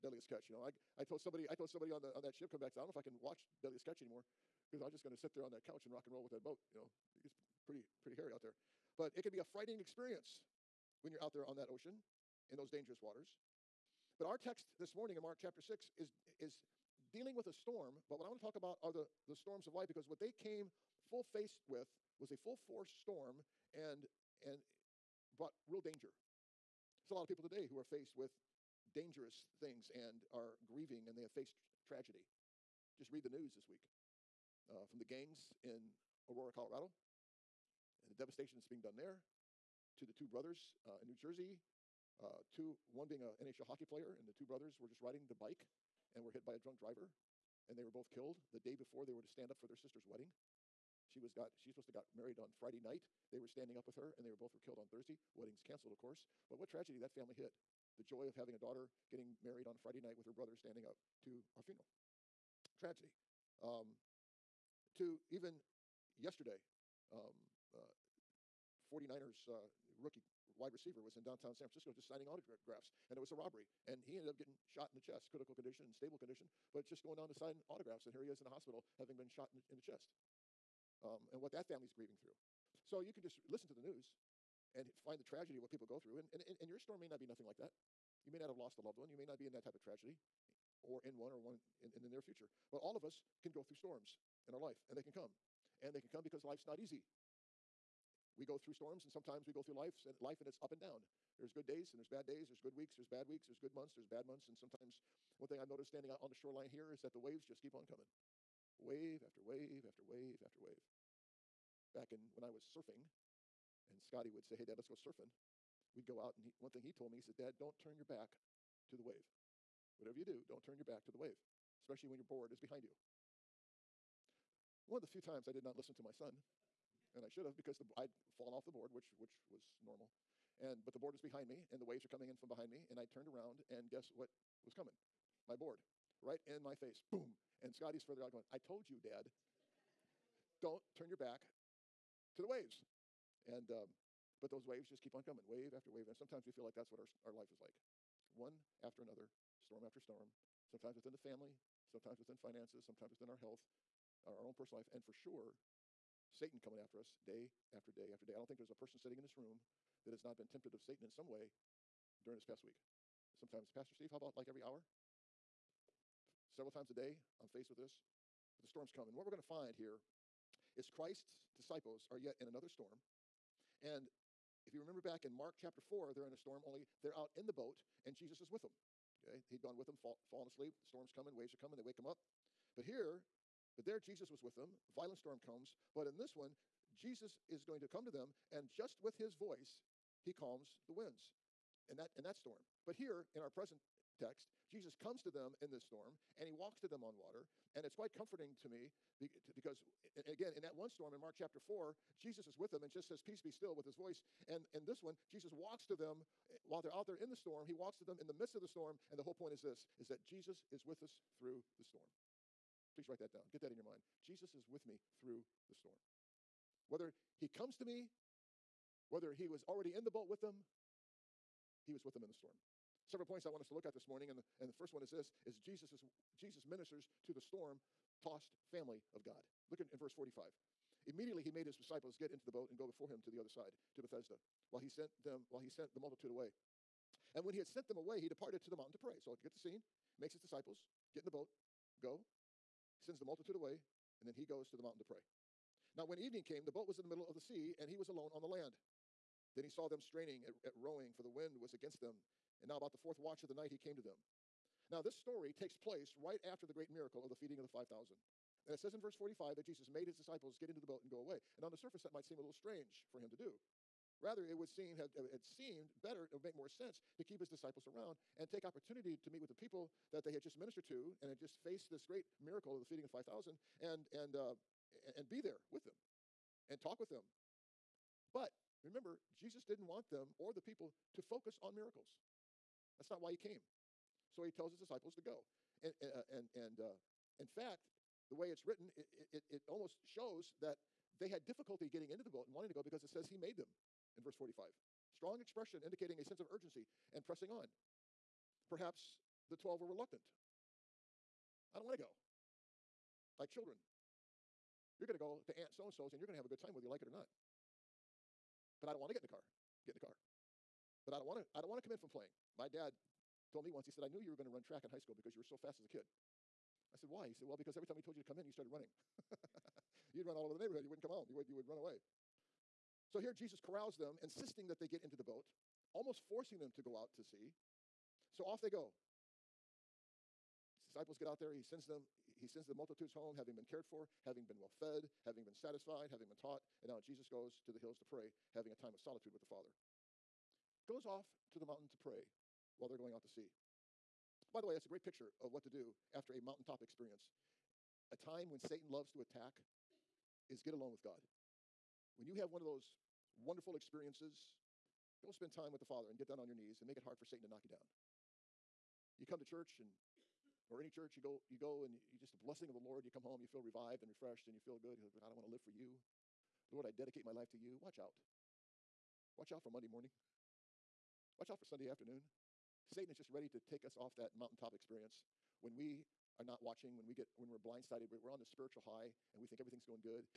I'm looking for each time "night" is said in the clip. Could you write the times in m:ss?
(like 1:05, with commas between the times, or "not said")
0:52, 1:00, 4:13.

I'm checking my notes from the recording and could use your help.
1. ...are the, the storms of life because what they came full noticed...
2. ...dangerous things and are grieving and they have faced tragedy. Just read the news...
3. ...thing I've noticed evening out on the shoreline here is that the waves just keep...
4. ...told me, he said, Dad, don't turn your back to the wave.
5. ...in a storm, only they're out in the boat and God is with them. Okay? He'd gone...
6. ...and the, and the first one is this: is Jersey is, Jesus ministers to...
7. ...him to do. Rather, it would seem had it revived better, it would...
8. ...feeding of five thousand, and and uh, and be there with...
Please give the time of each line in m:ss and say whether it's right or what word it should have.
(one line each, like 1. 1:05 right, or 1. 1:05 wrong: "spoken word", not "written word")
1. 0:18 wrong: "faced", not "noticed"
2. 0:28 right
3. 1:45 wrong: "standing", not "evening"
4. 1:56 right
5. 2:56 wrong: "Jesus", not "God"
6. 3:44 wrong: "Jesus", not "Jersey"
7. 4:23 wrong: "seemed", not "revived"
8. 4:32 right.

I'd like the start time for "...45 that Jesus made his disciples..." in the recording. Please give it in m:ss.
4:19.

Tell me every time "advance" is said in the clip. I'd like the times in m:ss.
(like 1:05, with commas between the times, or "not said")
not said.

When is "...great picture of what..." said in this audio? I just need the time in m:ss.
5:44.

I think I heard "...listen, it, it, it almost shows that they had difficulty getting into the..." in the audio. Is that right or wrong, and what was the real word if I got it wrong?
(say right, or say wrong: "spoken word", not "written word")
wrong: "written", not "listen".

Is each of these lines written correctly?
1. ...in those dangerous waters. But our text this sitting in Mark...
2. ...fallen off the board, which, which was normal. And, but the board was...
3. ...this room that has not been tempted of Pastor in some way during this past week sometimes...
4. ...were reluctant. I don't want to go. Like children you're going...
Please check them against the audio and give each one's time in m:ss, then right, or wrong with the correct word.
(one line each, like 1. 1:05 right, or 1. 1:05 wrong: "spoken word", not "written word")
1. 0:12 wrong: "morning", not "sitting"
2. 2:08 right
3. 2:39 wrong: "Satan", not "Pastor"
4. 4:59 right.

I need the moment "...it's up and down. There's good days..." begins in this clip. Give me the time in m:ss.
1:40.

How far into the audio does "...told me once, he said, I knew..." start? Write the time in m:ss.
5:13.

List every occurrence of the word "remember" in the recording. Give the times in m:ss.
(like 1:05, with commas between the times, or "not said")
2:54, 4:38.